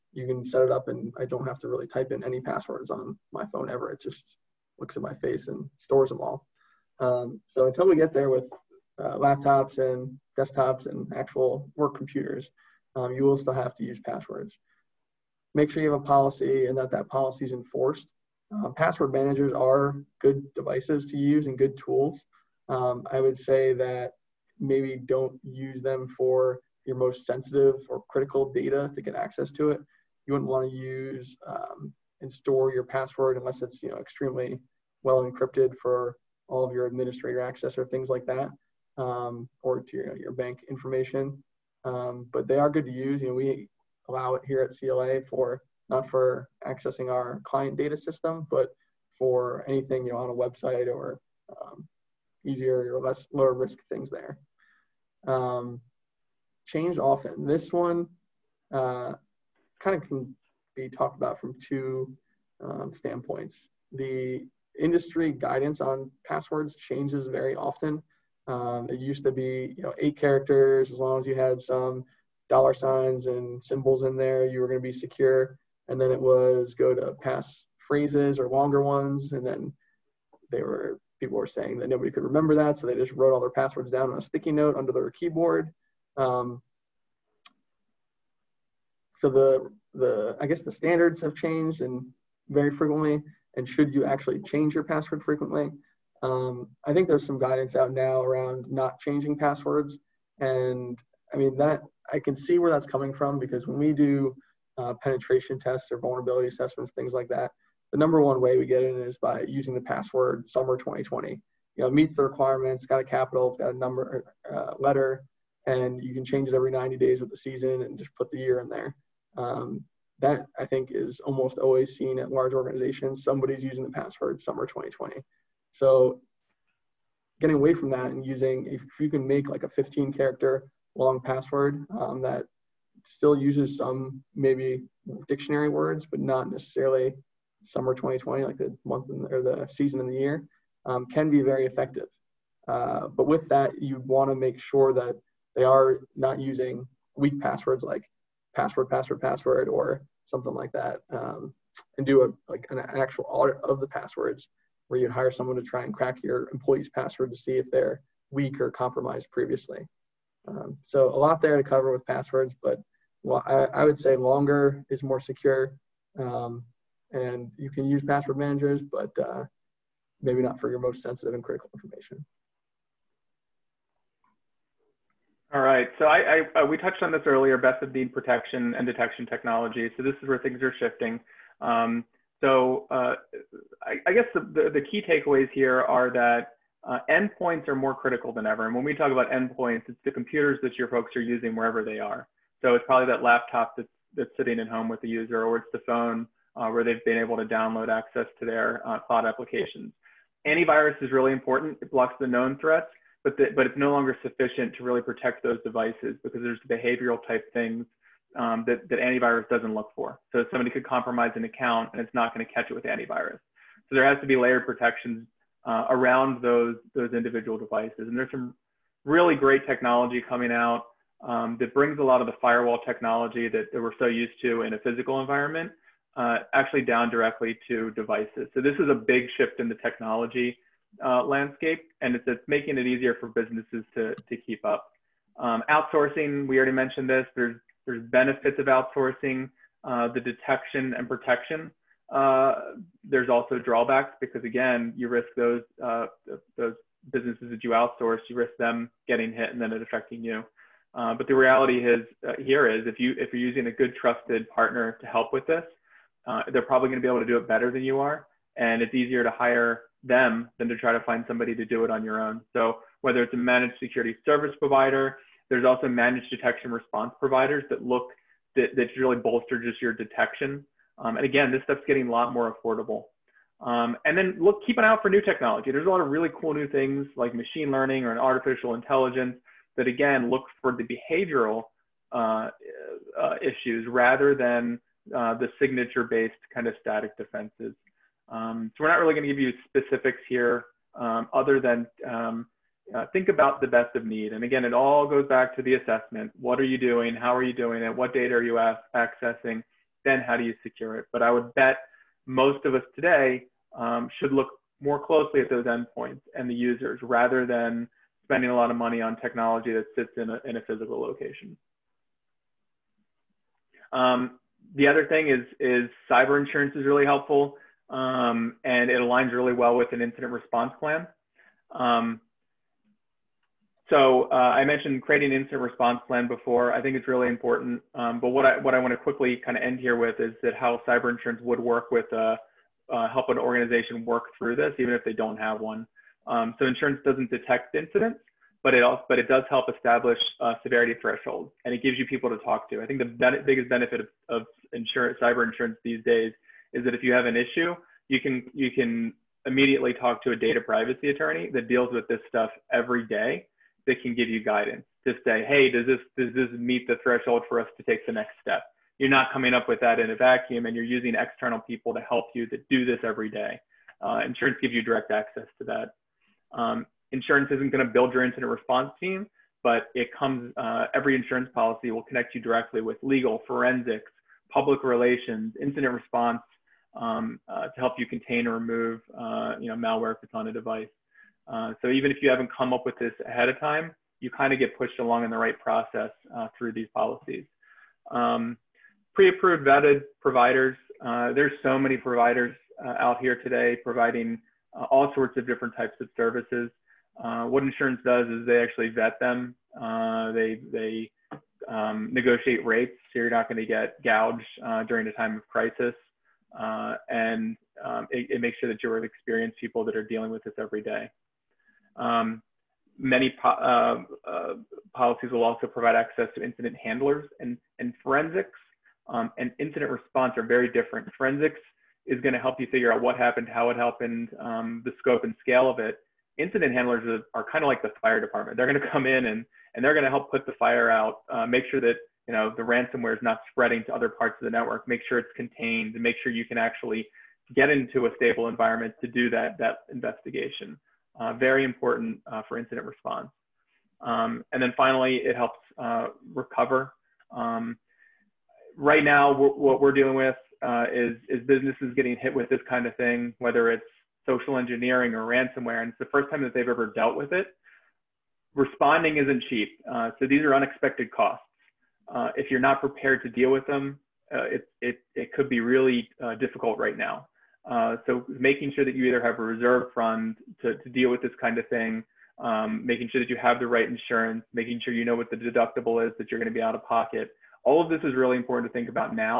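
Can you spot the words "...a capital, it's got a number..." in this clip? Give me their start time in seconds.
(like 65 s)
113 s.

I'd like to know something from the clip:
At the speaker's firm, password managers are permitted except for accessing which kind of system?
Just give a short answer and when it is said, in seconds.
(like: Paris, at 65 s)
client data system, at 47 s.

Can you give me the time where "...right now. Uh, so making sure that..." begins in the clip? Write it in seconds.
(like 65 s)
466 s.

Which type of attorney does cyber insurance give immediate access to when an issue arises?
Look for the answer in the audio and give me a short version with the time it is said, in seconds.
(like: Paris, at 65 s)
data privacy attorney, at 350 s.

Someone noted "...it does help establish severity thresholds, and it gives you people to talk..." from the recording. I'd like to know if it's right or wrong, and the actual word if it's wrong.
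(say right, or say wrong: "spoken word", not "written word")
right.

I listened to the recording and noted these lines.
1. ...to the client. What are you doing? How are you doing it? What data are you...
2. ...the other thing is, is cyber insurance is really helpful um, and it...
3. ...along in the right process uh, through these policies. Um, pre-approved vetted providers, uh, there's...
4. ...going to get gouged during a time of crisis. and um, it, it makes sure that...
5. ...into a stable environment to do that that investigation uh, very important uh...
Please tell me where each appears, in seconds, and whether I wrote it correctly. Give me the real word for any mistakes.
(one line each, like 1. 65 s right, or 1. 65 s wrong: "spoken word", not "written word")
1. 295 s wrong: "assessment", not "client"
2. 314 s right
3. 384 s right
4. 403 s right
5. 437 s right.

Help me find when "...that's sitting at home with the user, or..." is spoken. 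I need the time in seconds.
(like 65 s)
194 s.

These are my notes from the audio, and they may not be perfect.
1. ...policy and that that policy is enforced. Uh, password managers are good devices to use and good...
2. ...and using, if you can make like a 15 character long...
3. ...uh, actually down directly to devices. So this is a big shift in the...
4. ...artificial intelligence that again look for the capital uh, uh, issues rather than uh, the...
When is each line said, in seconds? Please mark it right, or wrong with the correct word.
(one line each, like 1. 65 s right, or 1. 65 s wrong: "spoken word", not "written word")
1. 16 s right
2. 128 s right
3. 226 s right
4. 278 s wrong: "behavioral", not "capital".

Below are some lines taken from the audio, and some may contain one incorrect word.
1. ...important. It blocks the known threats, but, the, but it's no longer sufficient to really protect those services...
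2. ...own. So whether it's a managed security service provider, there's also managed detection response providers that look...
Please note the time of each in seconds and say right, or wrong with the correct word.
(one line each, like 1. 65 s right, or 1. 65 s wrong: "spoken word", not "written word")
1. 201 s wrong: "devices", not "services"
2. 262 s right.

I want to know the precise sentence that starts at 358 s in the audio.
You're not coming up with that in a vacuum, and you're using external people to help you that do this every day.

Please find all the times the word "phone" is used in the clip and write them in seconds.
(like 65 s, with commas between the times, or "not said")
3 s, 195 s.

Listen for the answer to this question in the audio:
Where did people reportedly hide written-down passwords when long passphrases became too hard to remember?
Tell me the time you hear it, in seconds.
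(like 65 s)
84 s.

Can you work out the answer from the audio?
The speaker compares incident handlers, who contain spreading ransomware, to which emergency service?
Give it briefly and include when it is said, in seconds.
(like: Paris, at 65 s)
fire department, at 428 s.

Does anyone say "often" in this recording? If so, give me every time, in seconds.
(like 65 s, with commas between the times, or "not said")
56 s, 67 s.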